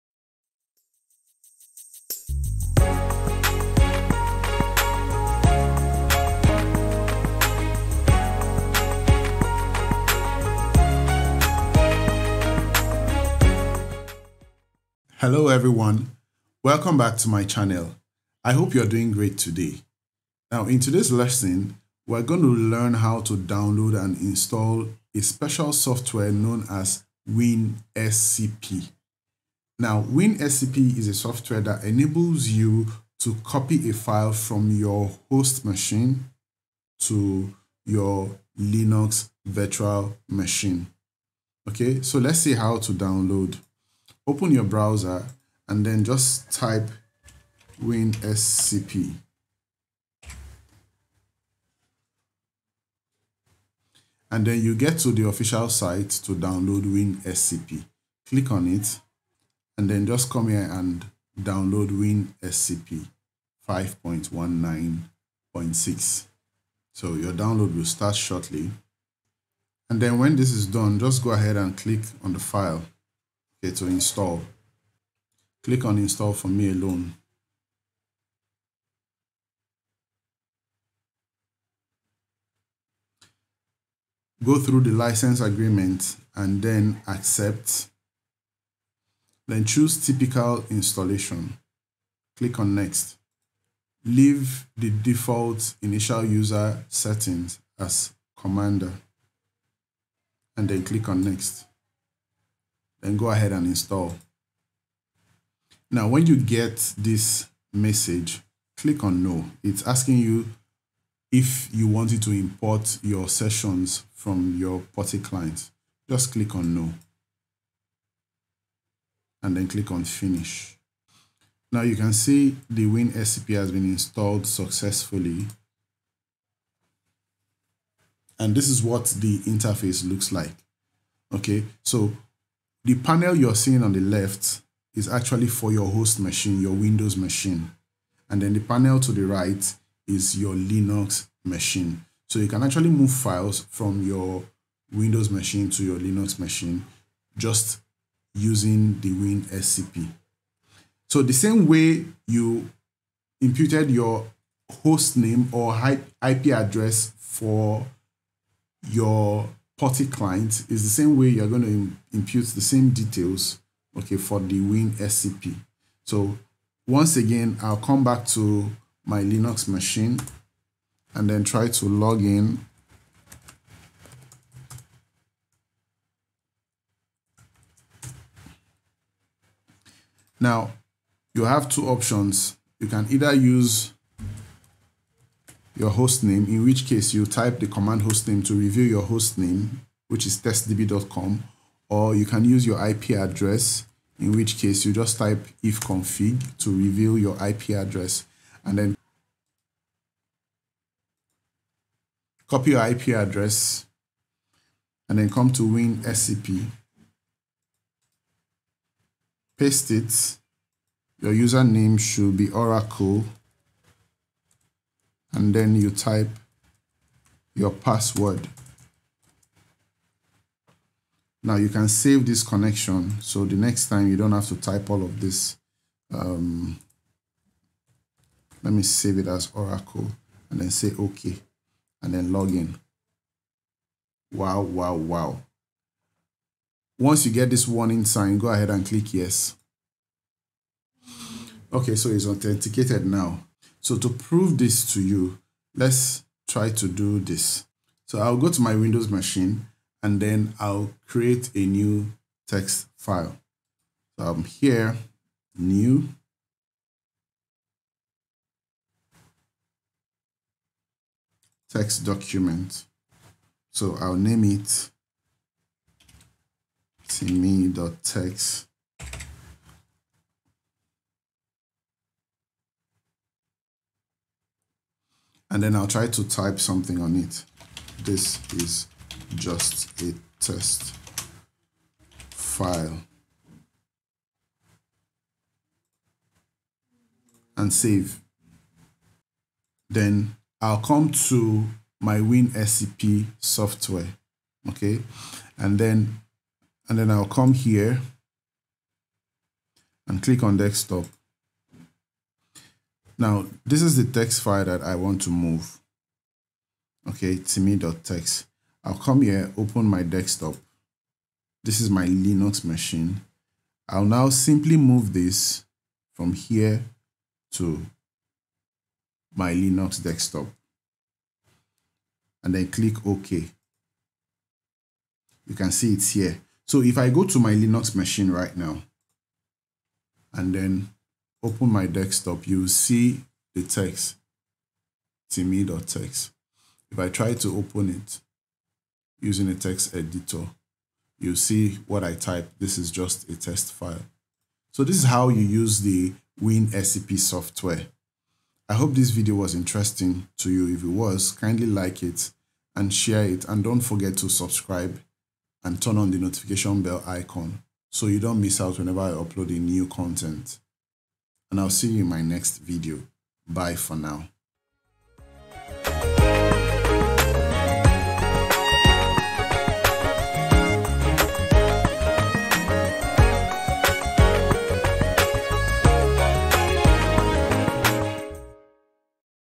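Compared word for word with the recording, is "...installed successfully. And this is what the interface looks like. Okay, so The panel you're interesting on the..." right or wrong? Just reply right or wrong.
wrong.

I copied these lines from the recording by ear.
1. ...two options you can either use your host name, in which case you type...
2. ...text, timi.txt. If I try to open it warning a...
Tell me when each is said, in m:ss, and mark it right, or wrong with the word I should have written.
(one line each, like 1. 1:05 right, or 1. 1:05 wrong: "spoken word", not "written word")
1. 3:01 right
2. 5:33 wrong: "using", not "warning".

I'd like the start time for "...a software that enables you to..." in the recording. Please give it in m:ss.
0:31.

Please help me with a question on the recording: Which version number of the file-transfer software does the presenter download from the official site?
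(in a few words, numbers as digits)
5.19.6.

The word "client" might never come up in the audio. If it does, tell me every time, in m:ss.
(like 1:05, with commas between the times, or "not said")
1:55, 2:40.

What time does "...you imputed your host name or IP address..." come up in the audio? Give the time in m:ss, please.
2:32.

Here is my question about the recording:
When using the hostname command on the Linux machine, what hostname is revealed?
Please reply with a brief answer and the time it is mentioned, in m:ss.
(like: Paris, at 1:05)
testdb.com, at 3:10.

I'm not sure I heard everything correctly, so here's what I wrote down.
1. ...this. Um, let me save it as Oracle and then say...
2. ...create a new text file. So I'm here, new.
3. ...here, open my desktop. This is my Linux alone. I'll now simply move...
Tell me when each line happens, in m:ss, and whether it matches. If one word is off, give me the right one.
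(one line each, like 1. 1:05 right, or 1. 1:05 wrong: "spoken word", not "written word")
1. 3:45 right
2. 4:11 right
3. 5:09 wrong: "machine", not "alone".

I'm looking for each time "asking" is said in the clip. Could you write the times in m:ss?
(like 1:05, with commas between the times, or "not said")
1:49.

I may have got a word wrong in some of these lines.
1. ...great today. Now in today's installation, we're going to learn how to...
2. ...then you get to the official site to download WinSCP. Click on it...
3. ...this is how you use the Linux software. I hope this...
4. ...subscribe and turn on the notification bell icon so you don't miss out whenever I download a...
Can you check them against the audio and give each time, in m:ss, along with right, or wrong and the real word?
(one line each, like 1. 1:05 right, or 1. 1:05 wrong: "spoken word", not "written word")
1. 0:19 wrong: "lesson", not "installation"
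2. 0:54 right
3. 5:44 wrong: "WinSCP", not "Linux"
4. 5:54 wrong: "upload", not "download".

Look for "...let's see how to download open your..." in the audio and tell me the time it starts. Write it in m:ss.
0:42.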